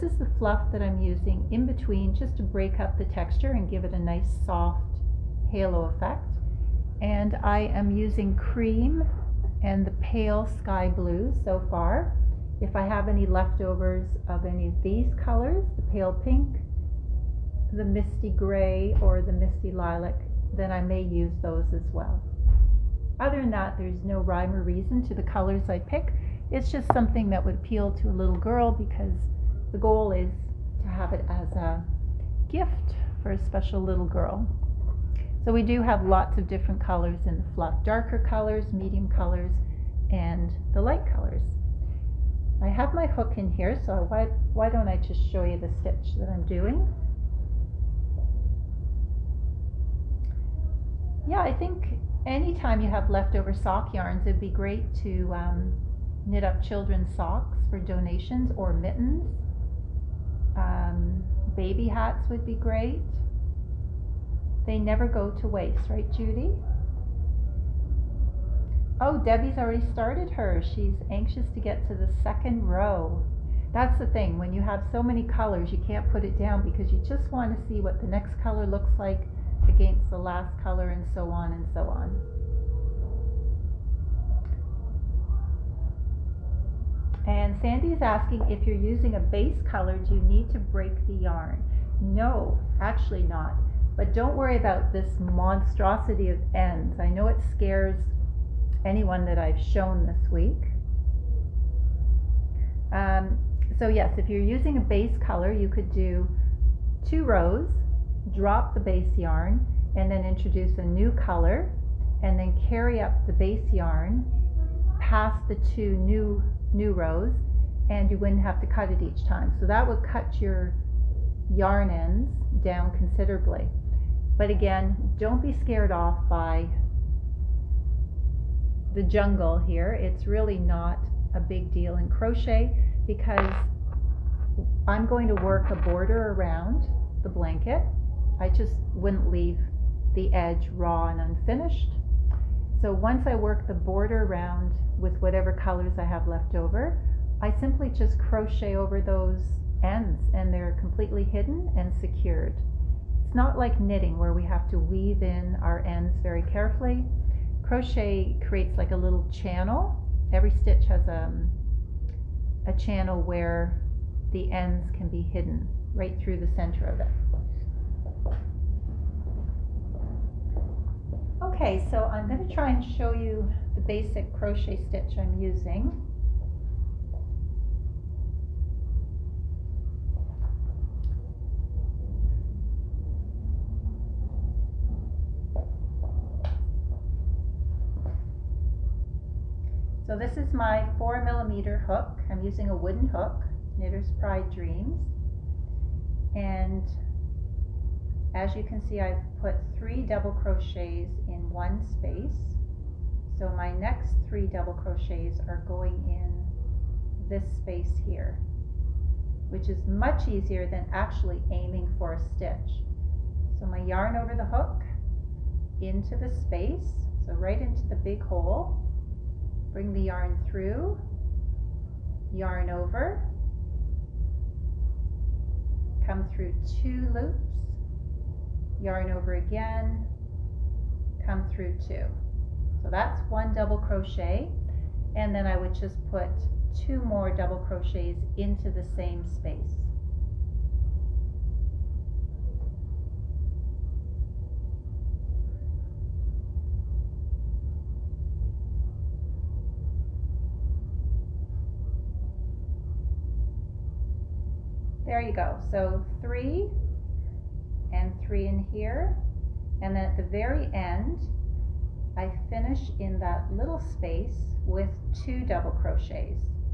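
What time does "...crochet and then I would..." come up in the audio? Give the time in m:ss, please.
3:53.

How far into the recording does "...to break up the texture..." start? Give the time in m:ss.
0:02.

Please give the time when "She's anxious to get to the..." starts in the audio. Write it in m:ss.
1:10.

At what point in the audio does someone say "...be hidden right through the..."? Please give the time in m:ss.
2:45.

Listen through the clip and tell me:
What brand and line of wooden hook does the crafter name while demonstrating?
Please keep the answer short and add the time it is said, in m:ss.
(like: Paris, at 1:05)
Knitter's Pride Dreamz, at 3:13.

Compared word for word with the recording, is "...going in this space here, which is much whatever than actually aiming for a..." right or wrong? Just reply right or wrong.
wrong.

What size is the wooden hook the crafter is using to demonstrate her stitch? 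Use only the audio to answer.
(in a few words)
4 millimeter.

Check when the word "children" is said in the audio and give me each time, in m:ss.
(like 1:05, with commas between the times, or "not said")
0:56.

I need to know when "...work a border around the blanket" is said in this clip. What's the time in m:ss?
2:15.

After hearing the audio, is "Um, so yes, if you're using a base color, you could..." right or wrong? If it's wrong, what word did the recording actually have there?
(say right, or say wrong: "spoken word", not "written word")
right.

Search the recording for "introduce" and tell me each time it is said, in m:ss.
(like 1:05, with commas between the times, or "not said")
1:50.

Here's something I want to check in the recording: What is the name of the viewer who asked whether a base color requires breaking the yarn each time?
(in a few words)
Sandy.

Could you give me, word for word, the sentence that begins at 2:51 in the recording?
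Okay, so I'm going to try and show you basic crochet stitch I'm using.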